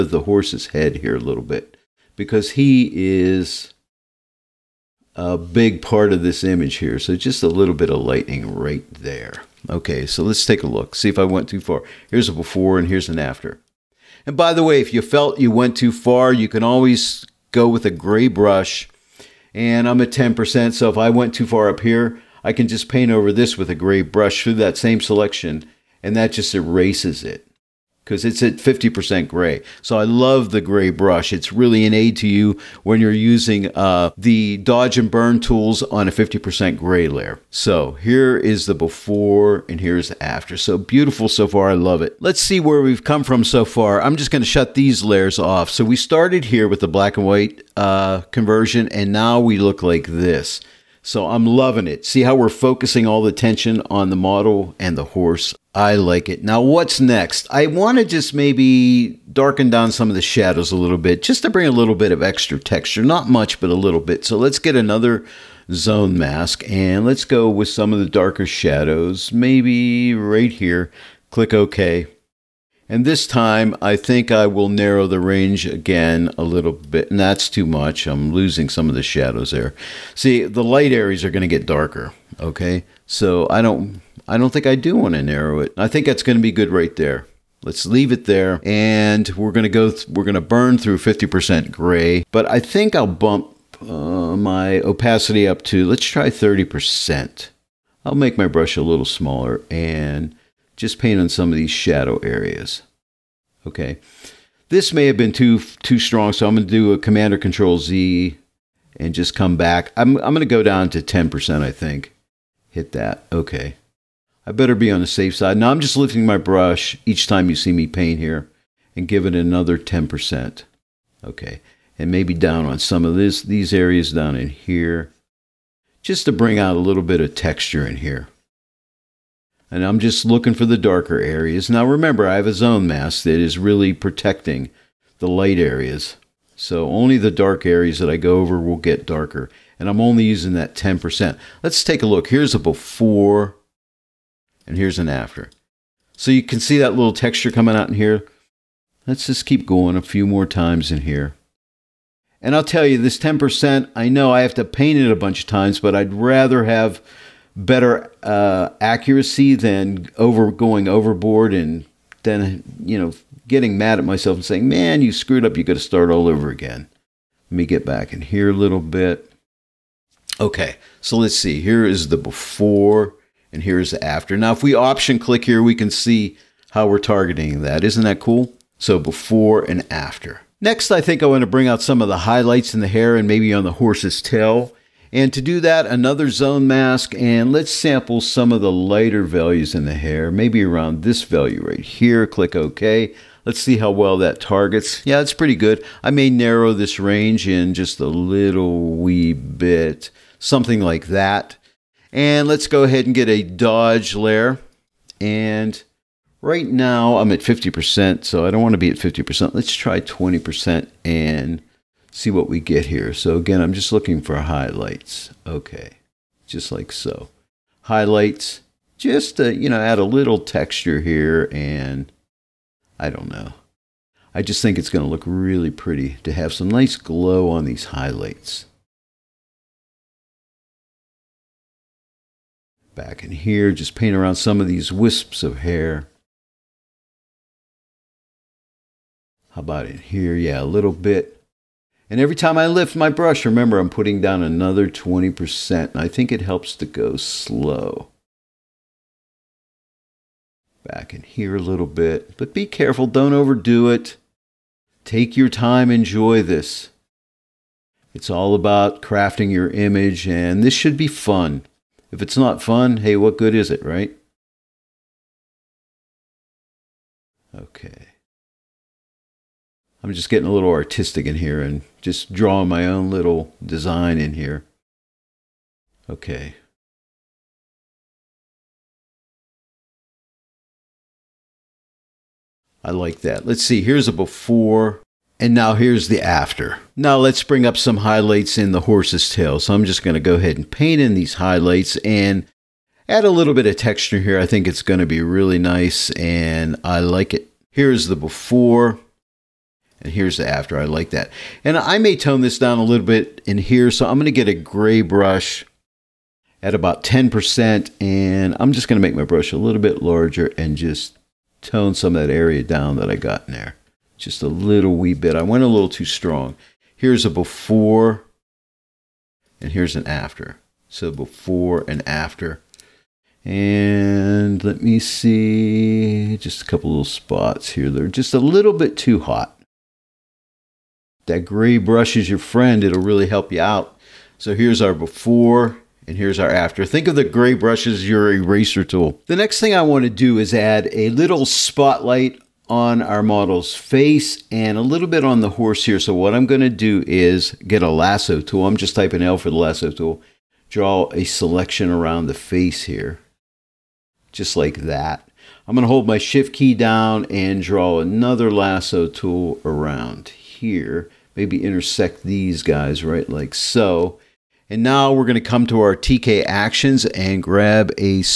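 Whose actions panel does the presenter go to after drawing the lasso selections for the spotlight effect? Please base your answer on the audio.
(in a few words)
TK actions.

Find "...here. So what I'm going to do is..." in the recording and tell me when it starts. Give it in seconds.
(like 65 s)
345 s.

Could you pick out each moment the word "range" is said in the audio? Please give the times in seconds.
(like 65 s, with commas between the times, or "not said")
75 s, 196 s.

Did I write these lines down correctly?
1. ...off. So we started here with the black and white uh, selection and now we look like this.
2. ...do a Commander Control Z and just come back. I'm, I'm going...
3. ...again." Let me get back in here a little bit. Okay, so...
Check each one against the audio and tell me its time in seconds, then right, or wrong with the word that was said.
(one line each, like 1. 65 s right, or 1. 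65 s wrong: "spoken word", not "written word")
1. 45 s wrong: "conversion", not "selection"
2. 106 s right
3. 166 s right.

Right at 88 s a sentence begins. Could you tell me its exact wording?
And we're going to go, we're going to burn through 50% gray.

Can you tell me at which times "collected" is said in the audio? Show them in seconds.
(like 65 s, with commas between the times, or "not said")
not said.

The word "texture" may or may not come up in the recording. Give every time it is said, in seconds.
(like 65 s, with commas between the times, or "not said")
62 s, 127 s, 147 s, 220 s, 293 s.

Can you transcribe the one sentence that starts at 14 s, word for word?
And by the way, if you felt you went too far, you can always go with a gray brush.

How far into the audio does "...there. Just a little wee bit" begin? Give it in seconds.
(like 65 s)
313 s.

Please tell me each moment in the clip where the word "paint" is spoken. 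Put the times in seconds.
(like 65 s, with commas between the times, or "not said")
22 s, 100 s, 117 s, 154 s, 233 s, 290 s.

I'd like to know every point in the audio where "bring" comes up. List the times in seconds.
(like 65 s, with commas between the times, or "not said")
61 s, 126 s, 181 s, 287 s.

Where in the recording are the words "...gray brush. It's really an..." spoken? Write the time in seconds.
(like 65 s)
30 s.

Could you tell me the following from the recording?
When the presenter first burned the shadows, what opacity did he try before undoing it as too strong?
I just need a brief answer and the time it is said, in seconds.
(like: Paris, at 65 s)
30%, at 96 s.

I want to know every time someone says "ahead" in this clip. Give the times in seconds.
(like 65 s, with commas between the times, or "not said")
202 s, 290 s.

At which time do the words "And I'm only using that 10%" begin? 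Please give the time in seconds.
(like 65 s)
139 s.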